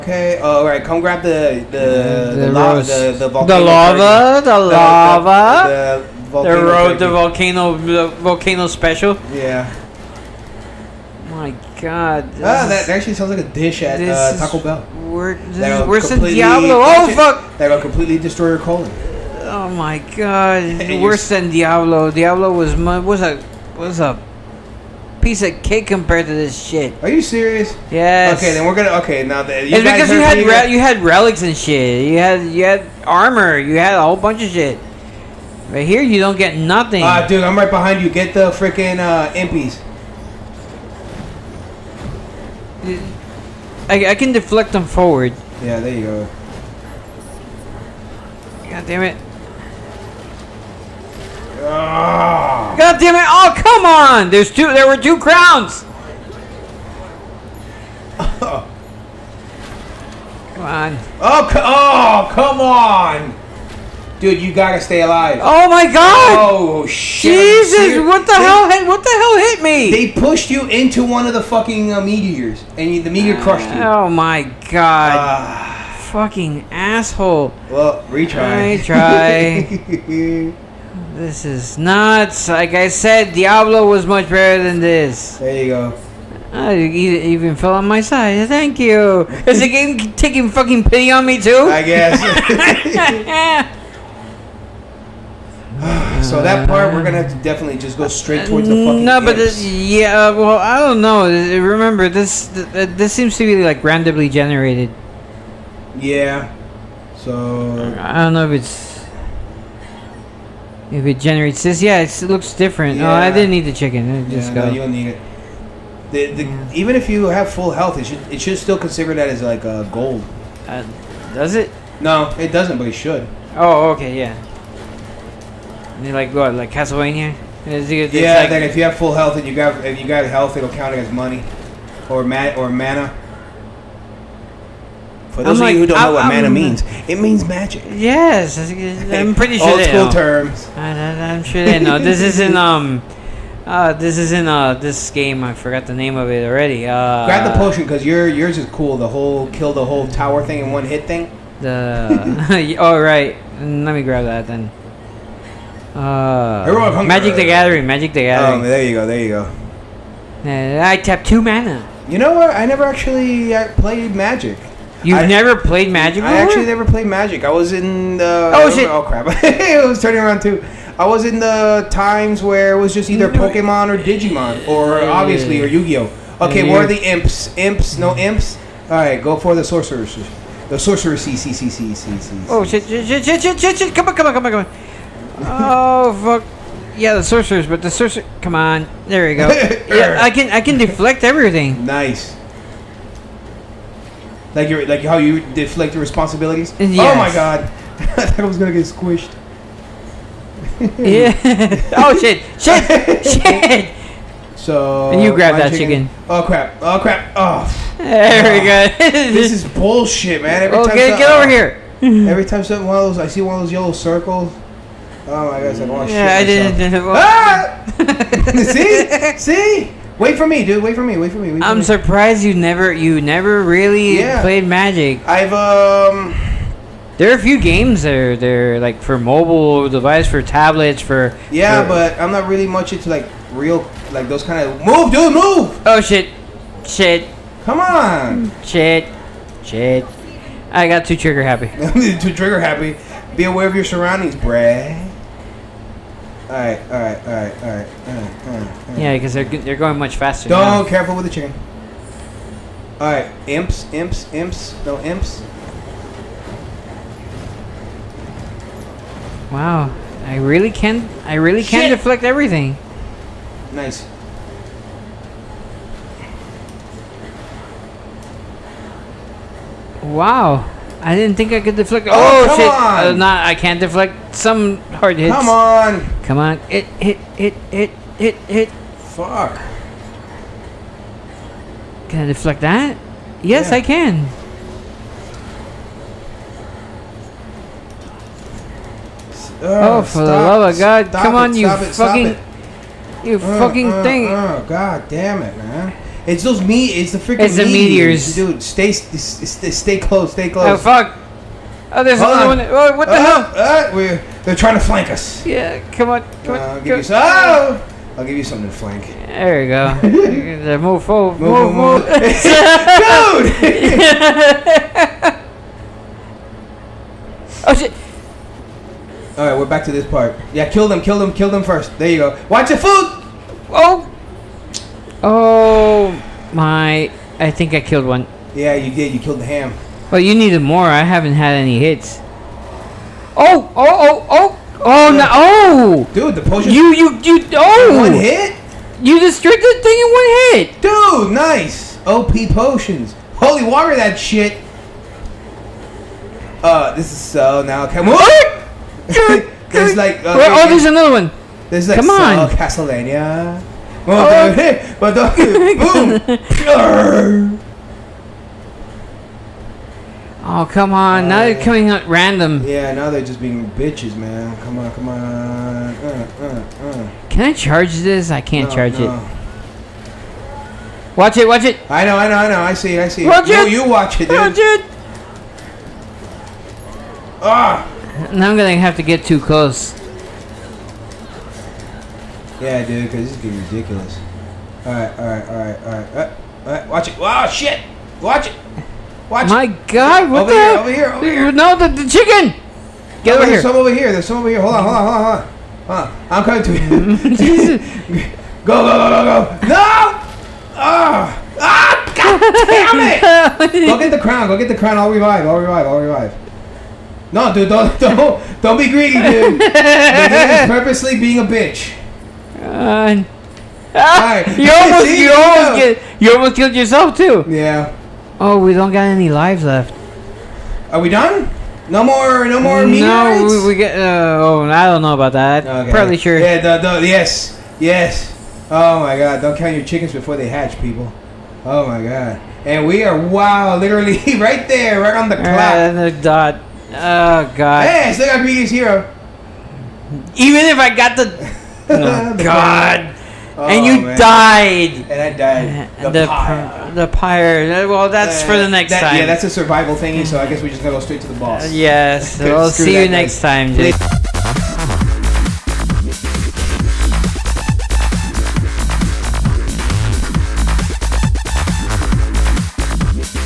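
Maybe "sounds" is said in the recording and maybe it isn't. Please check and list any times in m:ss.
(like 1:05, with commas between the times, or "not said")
0:13.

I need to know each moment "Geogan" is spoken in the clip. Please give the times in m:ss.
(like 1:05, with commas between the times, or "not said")
not said.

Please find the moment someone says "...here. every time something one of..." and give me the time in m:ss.
3:31.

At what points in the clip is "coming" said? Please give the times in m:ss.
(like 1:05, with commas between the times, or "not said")
6:01, 6:36.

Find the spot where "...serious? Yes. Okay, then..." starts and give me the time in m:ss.
0:27.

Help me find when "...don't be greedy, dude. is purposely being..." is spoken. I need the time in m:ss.
6:48.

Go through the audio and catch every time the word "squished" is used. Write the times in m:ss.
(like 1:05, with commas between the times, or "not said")
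3:18.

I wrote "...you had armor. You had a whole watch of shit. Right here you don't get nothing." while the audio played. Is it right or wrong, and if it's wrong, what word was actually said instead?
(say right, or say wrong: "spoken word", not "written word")
wrong: "bunch", not "watch".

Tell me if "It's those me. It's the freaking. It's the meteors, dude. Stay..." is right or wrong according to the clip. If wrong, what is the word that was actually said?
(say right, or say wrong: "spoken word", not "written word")
right.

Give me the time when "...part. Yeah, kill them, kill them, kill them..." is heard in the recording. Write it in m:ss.
5:20.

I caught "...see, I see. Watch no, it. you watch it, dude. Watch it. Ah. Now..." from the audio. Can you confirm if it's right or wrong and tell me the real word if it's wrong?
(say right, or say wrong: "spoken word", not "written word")
right.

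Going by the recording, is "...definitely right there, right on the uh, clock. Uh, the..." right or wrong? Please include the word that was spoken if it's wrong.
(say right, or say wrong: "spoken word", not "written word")
wrong: "literally", not "definitely".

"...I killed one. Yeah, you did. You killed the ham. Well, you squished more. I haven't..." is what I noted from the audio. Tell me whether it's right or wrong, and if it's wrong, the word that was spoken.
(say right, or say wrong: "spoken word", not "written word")
wrong: "needed", not "squished".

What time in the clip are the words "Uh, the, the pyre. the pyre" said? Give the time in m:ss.
7:25.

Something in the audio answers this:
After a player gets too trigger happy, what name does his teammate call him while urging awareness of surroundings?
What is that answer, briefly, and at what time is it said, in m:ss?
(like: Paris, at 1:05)
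Brad, at 4:04.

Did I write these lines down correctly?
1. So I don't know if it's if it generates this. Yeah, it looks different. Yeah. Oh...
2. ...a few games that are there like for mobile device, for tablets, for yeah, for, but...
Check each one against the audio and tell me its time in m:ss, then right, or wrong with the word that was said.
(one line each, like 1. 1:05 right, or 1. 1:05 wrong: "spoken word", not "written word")
1. 1:47 right
2. 3:47 right.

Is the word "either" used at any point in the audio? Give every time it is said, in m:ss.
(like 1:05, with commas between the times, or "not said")
2:53.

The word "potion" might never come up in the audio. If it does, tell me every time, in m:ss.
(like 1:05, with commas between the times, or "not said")
2:27, 5:36, 5:42.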